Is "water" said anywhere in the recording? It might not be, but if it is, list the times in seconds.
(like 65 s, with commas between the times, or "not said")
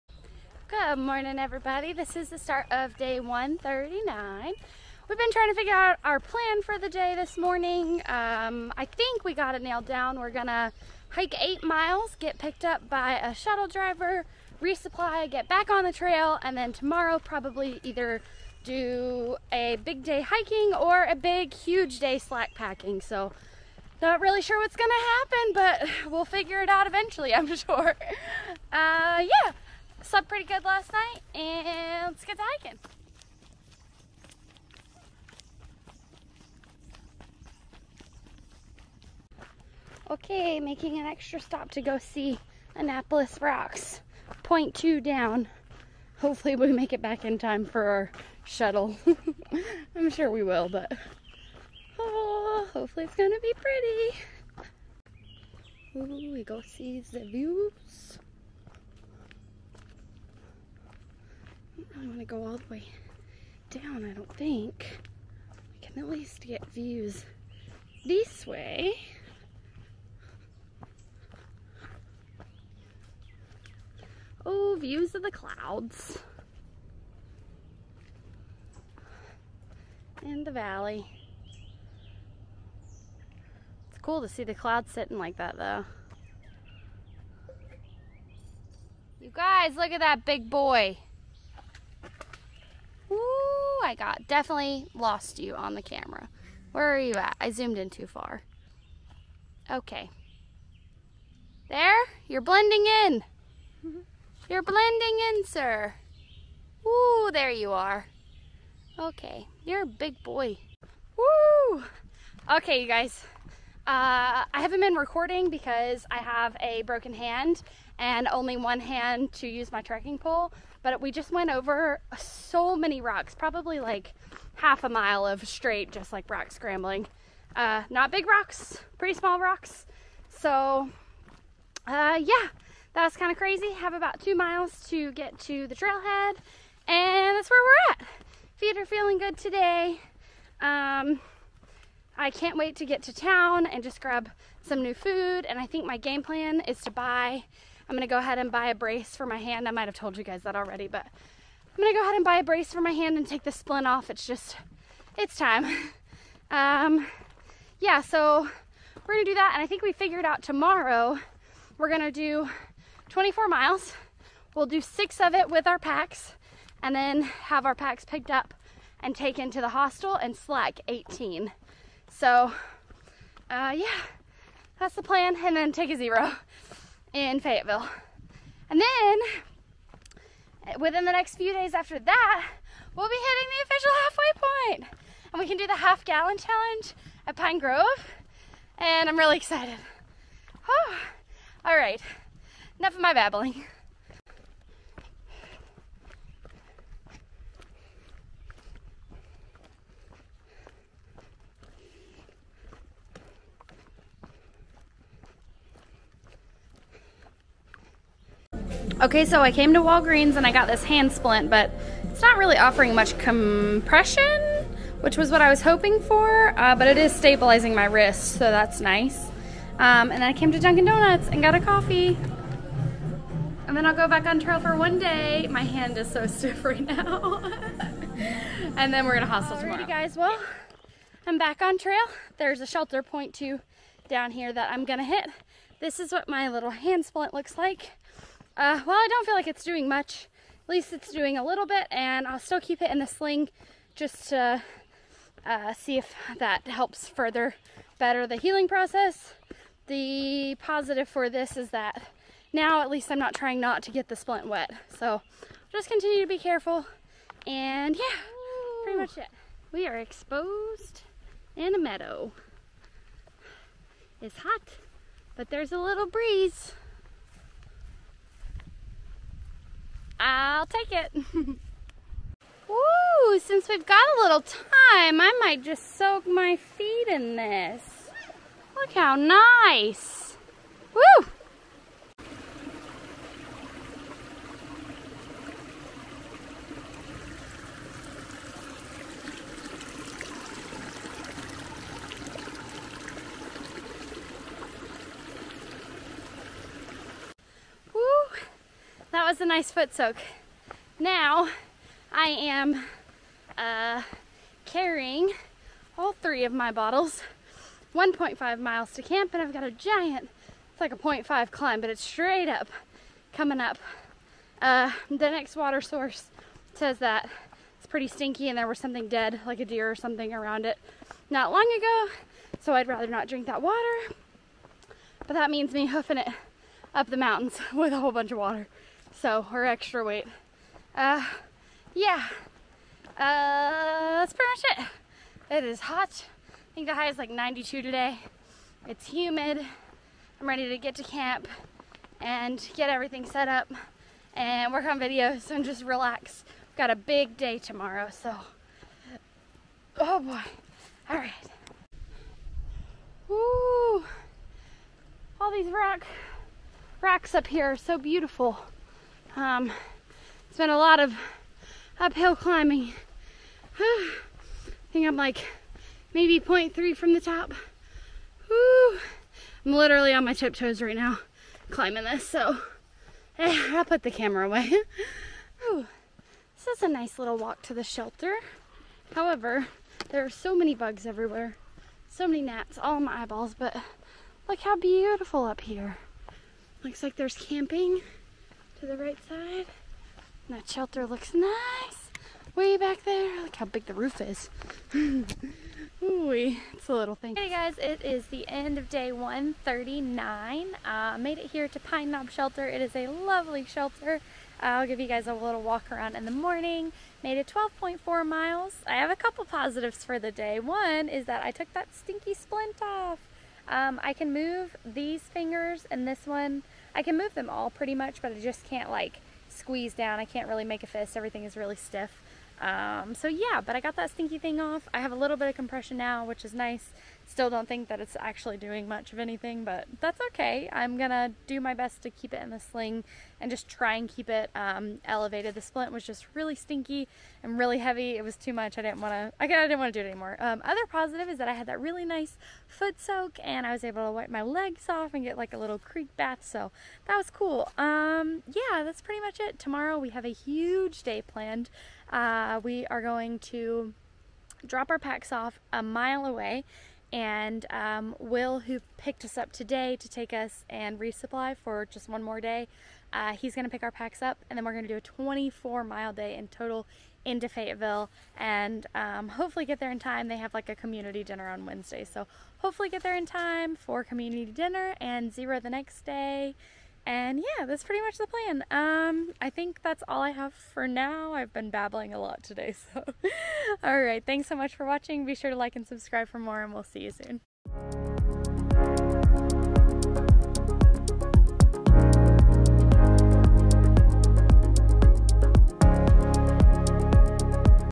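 315 s, 323 s, 328 s.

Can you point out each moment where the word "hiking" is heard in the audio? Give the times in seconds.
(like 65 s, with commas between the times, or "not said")
20 s, 32 s.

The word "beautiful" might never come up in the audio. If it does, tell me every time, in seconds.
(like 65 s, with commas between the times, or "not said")
357 s, 384 s.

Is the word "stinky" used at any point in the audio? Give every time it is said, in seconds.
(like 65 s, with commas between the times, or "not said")
318 s, 411 s, 424 s, 436 s.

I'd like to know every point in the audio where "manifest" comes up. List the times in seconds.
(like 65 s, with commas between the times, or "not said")
not said.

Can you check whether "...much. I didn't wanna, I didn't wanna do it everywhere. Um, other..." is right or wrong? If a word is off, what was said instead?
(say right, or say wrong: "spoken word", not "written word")
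wrong: "anymore", not "everywhere".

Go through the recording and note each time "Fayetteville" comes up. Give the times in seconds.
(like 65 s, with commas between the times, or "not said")
177 s, 467 s.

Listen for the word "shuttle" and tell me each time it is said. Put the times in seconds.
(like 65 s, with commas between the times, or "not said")
13 s, 48 s.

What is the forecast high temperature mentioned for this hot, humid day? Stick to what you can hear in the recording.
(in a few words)
92.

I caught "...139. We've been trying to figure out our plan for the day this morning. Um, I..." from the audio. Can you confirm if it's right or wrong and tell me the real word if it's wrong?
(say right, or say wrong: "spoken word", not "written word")
right.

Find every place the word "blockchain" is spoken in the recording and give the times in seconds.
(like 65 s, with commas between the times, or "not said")
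not said.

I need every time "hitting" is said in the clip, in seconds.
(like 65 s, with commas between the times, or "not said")
183 s.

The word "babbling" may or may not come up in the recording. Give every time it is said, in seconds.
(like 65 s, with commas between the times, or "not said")
193 s, 481 s.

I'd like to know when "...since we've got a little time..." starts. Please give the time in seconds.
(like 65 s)
273 s.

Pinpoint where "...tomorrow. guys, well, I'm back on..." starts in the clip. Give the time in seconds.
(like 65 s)
229 s.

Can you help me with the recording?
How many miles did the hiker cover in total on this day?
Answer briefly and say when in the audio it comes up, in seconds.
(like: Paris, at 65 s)
12.4 miles, at 407 s.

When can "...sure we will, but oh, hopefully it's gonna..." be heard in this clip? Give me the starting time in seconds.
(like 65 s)
50 s.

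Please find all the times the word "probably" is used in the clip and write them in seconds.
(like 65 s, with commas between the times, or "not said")
17 s, 123 s.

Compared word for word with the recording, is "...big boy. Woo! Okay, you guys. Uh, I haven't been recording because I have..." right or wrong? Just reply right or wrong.
right.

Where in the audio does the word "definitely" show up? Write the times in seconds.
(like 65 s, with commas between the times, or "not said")
94 s.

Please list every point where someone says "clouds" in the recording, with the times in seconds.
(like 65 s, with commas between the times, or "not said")
75 s, 84 s.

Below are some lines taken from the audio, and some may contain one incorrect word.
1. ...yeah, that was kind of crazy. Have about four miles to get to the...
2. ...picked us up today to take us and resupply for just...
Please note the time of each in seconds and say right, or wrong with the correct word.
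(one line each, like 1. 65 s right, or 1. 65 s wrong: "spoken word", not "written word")
1. 132 s wrong: "two", not "four"
2. 458 s right.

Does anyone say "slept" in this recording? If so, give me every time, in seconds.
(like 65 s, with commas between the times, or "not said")
30 s.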